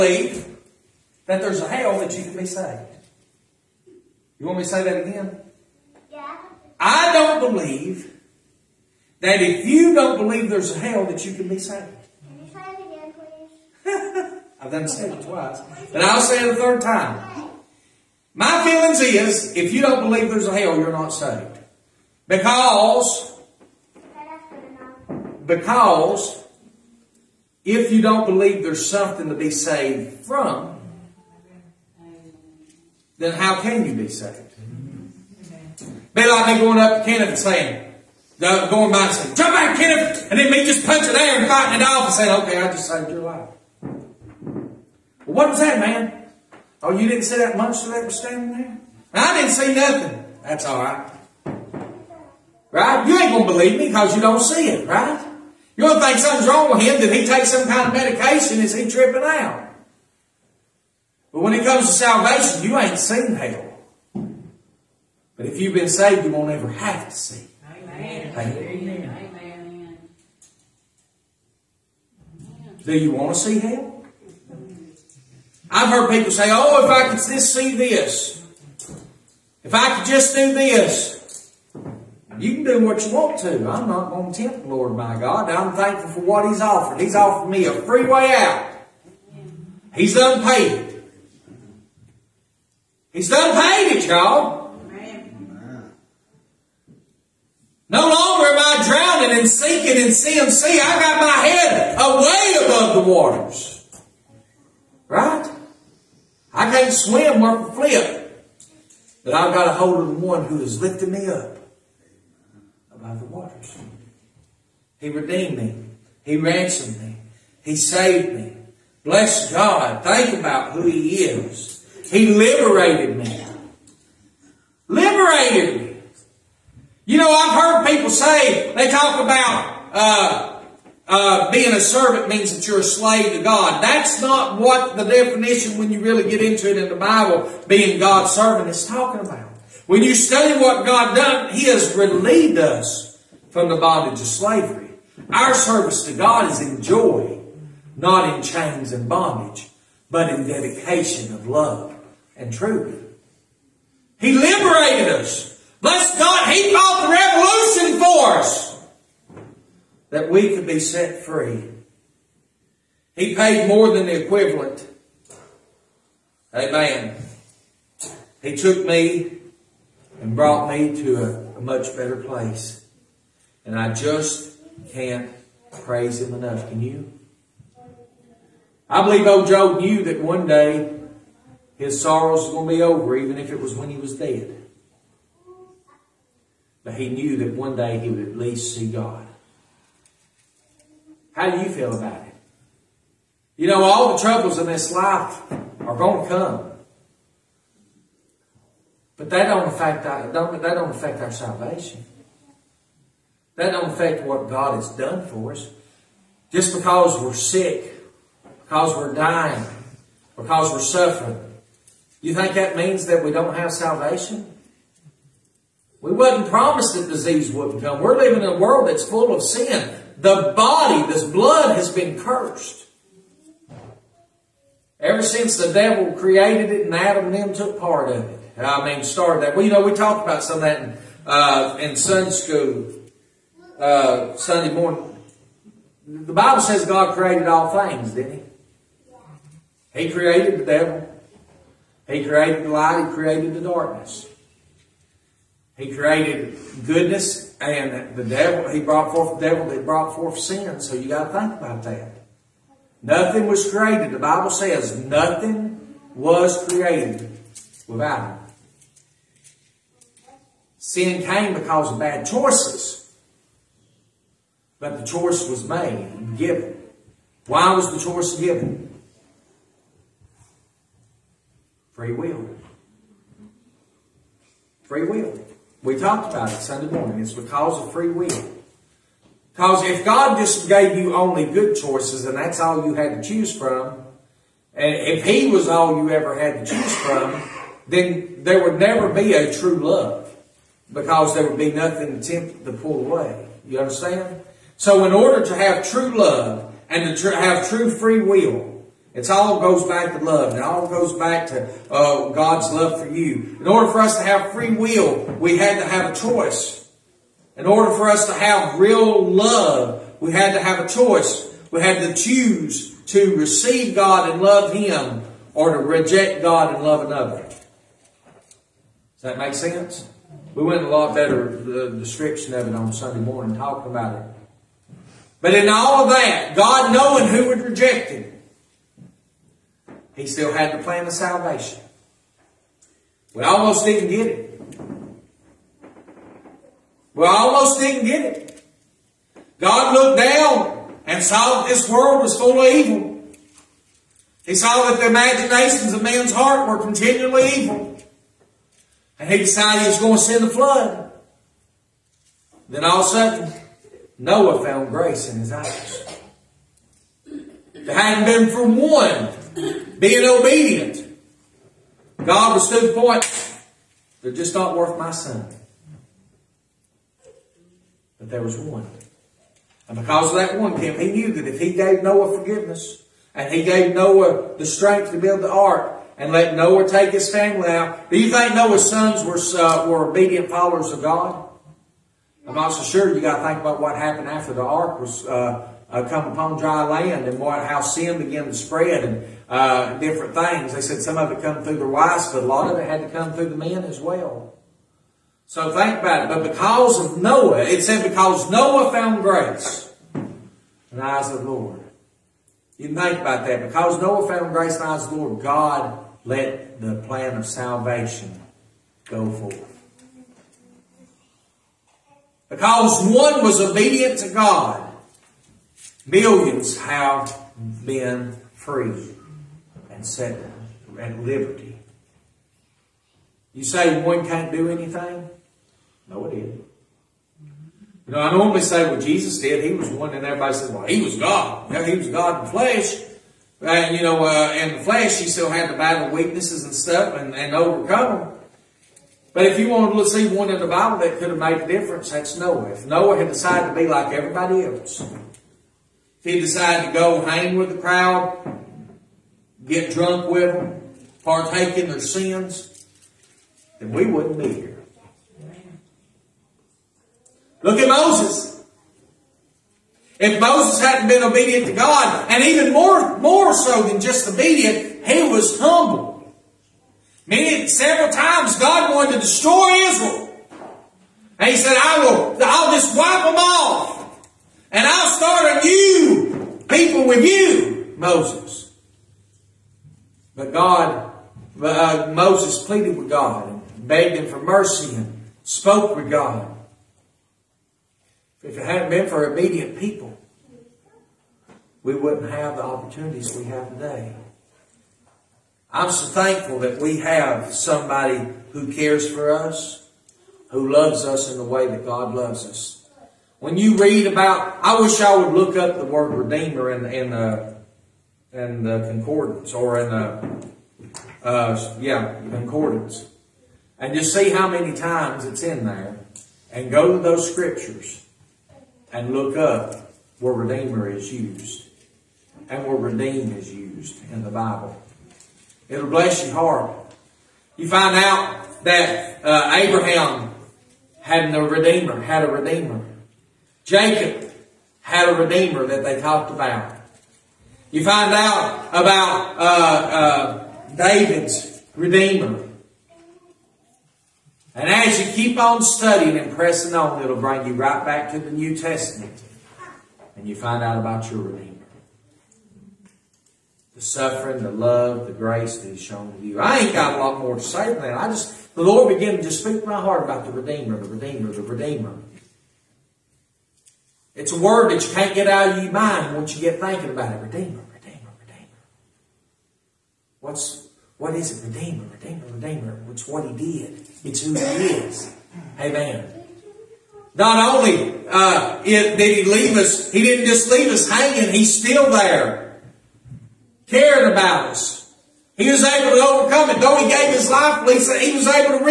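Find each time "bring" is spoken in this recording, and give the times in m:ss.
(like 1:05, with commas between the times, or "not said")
9:07.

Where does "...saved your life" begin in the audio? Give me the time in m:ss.
0:42.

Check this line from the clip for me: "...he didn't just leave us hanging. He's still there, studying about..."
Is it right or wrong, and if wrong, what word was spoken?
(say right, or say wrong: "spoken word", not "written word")
wrong: "caring", not "studying".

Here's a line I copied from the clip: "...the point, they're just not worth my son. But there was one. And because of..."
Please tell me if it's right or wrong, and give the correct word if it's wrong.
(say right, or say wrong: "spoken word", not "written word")
right.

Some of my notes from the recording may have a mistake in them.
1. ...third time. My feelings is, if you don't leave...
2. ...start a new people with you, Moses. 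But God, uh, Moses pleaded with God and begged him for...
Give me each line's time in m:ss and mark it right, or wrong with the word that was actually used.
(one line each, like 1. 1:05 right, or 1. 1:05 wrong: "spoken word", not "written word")
1. 0:16 wrong: "believe", not "leave"
2. 7:55 right.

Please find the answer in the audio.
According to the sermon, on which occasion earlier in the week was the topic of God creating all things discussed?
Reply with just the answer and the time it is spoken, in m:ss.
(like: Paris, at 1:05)
Sunday school, at 3:51.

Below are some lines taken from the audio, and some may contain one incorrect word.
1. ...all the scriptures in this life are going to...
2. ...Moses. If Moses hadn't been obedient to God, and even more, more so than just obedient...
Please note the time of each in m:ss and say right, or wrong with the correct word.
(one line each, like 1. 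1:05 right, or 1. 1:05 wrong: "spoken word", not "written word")
1. 3:13 wrong: "troubles", not "scriptures"
2. 7:37 right.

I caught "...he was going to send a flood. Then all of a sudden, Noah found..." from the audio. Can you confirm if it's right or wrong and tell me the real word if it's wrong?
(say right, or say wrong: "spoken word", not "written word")
right.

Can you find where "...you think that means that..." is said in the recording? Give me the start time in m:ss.
3:32.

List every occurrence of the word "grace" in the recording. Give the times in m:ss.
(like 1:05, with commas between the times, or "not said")
5:54, 6:39, 6:44, 9:15.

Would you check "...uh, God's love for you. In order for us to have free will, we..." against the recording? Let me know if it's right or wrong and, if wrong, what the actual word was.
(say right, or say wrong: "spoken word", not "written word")
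right.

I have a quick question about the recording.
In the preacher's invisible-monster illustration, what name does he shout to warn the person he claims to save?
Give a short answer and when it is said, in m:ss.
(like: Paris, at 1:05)
Kenneth, at 0:39.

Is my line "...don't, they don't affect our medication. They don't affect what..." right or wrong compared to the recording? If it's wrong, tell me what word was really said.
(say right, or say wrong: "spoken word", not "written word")
wrong: "salvation", not "medication".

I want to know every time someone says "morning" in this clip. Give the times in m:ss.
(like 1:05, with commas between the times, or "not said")
3:54, 4:36, 5:23.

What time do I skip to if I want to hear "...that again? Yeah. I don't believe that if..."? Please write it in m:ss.
0:04.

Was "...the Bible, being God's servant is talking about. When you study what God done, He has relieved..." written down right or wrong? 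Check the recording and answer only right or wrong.
right.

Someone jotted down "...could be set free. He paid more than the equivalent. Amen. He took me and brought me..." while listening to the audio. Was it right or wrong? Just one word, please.
right.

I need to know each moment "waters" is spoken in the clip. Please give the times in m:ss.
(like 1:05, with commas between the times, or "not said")
1:43, 1:53.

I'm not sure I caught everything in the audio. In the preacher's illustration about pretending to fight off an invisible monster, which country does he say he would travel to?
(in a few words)
Canada.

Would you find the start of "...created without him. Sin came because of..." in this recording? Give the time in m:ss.
4:16.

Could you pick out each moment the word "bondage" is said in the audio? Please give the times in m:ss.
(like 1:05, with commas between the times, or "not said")
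2:23, 2:29.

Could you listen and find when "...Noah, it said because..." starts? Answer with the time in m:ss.
6:37.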